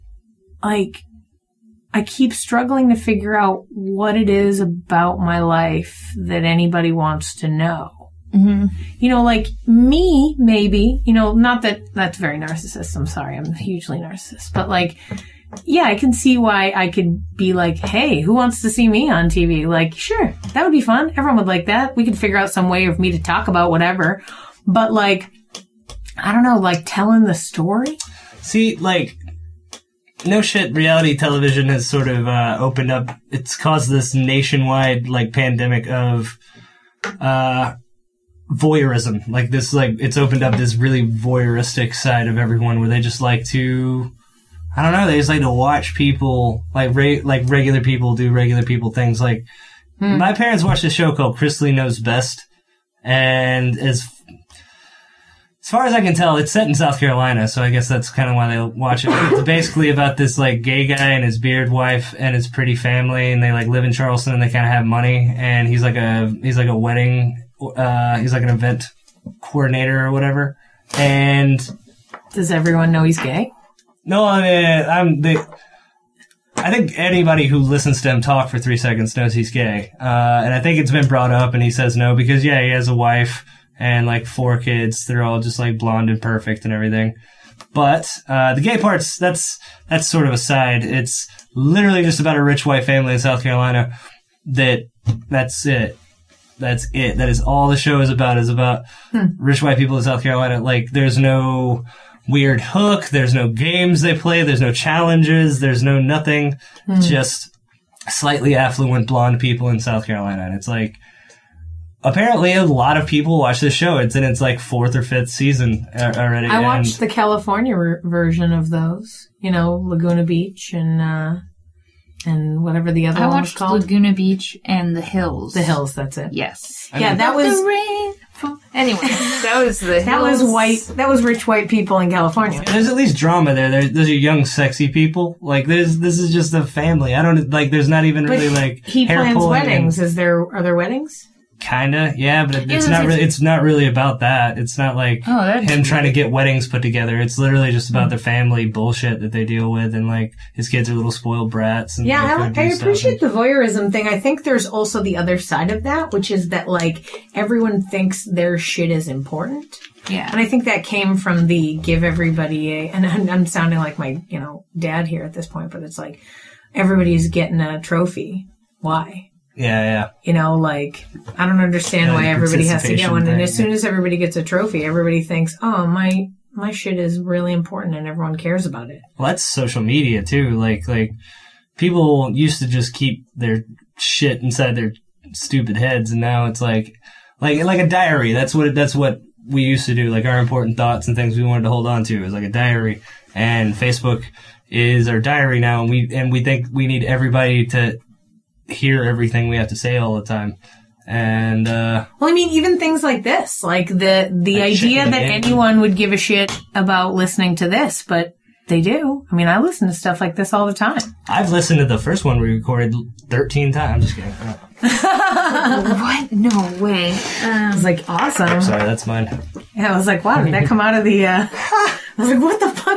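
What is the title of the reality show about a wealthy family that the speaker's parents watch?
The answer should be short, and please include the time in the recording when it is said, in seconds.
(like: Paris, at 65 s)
Chrisley Knows Best, at 51 s.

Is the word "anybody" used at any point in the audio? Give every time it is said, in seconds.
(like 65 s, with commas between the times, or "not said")
6 s, 76 s.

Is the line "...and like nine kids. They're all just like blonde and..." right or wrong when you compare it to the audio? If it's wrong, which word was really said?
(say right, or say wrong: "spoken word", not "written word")
wrong: "four", not "nine".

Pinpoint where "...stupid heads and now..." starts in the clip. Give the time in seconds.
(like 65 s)
185 s.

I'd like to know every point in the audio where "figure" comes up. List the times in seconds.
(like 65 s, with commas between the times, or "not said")
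2 s, 22 s.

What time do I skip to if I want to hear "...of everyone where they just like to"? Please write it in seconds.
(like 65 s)
42 s.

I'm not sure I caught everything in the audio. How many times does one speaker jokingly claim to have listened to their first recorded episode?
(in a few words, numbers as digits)
13.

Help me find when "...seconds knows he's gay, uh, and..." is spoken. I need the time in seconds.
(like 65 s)
78 s.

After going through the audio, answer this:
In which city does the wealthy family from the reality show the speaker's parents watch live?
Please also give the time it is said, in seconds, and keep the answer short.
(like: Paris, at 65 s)
Charleston, at 63 s.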